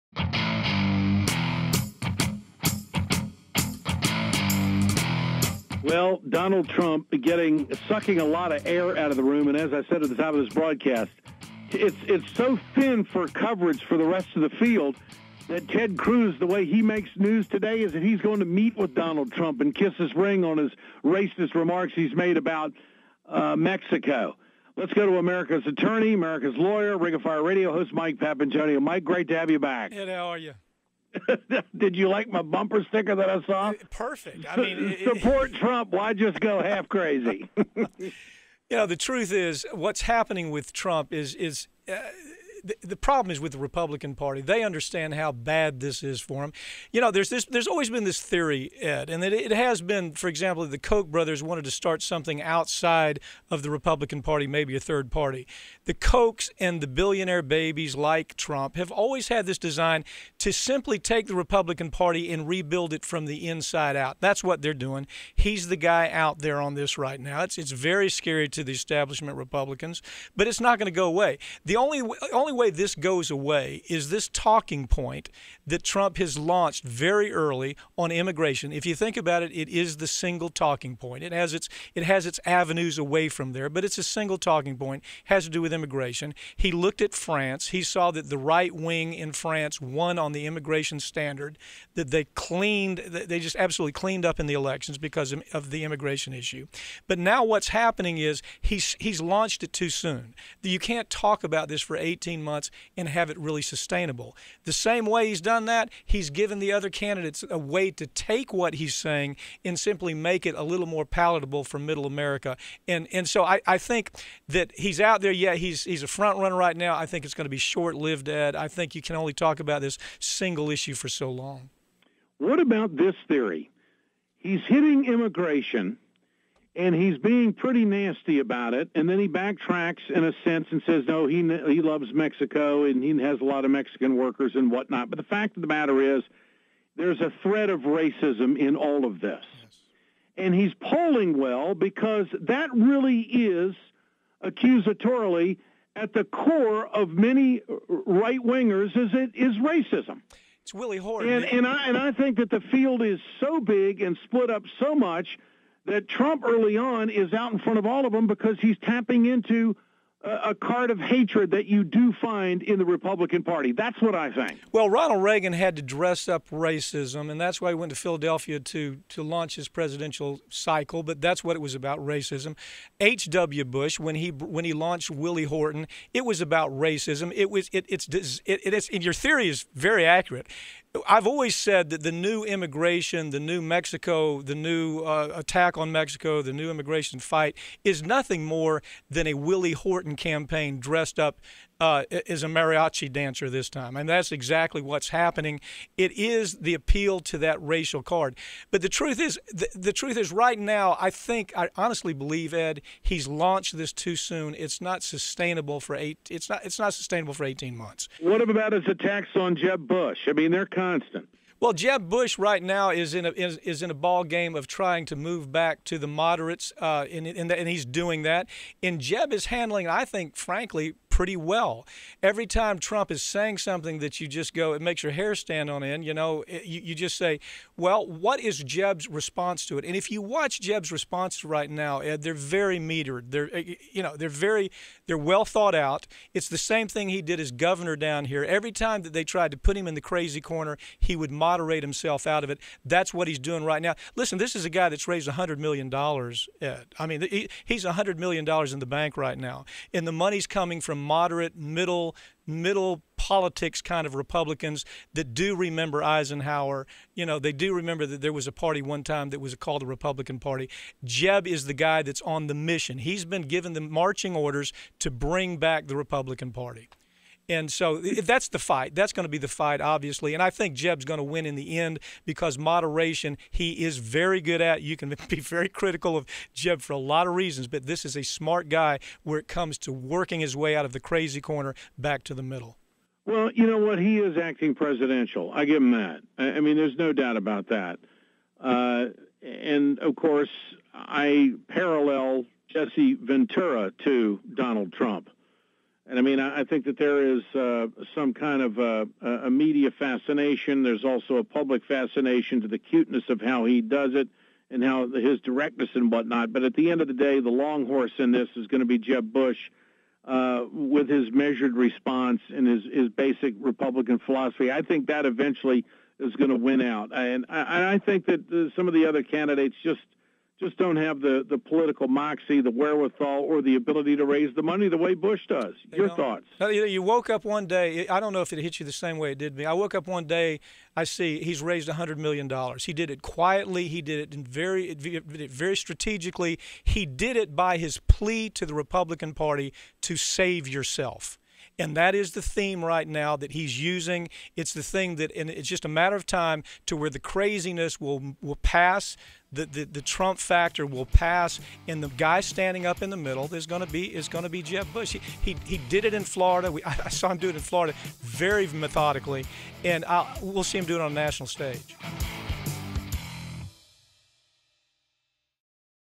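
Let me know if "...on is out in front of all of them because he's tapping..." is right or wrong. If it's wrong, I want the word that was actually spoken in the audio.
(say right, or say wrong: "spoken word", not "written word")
right.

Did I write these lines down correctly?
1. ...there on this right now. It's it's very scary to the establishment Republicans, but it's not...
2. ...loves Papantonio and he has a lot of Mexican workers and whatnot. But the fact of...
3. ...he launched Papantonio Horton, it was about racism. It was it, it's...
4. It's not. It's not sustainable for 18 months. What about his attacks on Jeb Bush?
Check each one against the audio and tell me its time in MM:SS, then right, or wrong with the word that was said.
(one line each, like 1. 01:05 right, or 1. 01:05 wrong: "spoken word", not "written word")
1. 01:06 right
2. 02:11 wrong: "Mexico", not "Papantonio"
3. 02:54 wrong: "Willie", not "Papantonio"
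4. 03:26 right.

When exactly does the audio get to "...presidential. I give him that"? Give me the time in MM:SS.
04:44.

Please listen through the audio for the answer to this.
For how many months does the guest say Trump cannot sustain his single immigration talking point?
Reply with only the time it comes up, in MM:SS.
01:41.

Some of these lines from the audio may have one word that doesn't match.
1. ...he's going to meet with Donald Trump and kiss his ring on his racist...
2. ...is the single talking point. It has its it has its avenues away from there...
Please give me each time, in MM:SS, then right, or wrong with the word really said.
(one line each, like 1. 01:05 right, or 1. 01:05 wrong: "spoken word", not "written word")
1. 00:18 right
2. 01:19 right.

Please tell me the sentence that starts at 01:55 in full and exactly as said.
Yeah, he's he's a front runner right now.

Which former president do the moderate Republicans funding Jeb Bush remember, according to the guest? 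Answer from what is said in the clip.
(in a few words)
Eisenhower.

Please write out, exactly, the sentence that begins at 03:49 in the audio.
And if you watch Jeb's response right now, Ed, they're very metered.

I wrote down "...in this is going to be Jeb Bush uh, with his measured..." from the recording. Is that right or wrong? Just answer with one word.
right.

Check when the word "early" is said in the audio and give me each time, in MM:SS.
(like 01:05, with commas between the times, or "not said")
01:17, 02:36.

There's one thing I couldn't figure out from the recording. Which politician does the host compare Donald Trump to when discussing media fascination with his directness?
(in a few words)
Jesse Ventura.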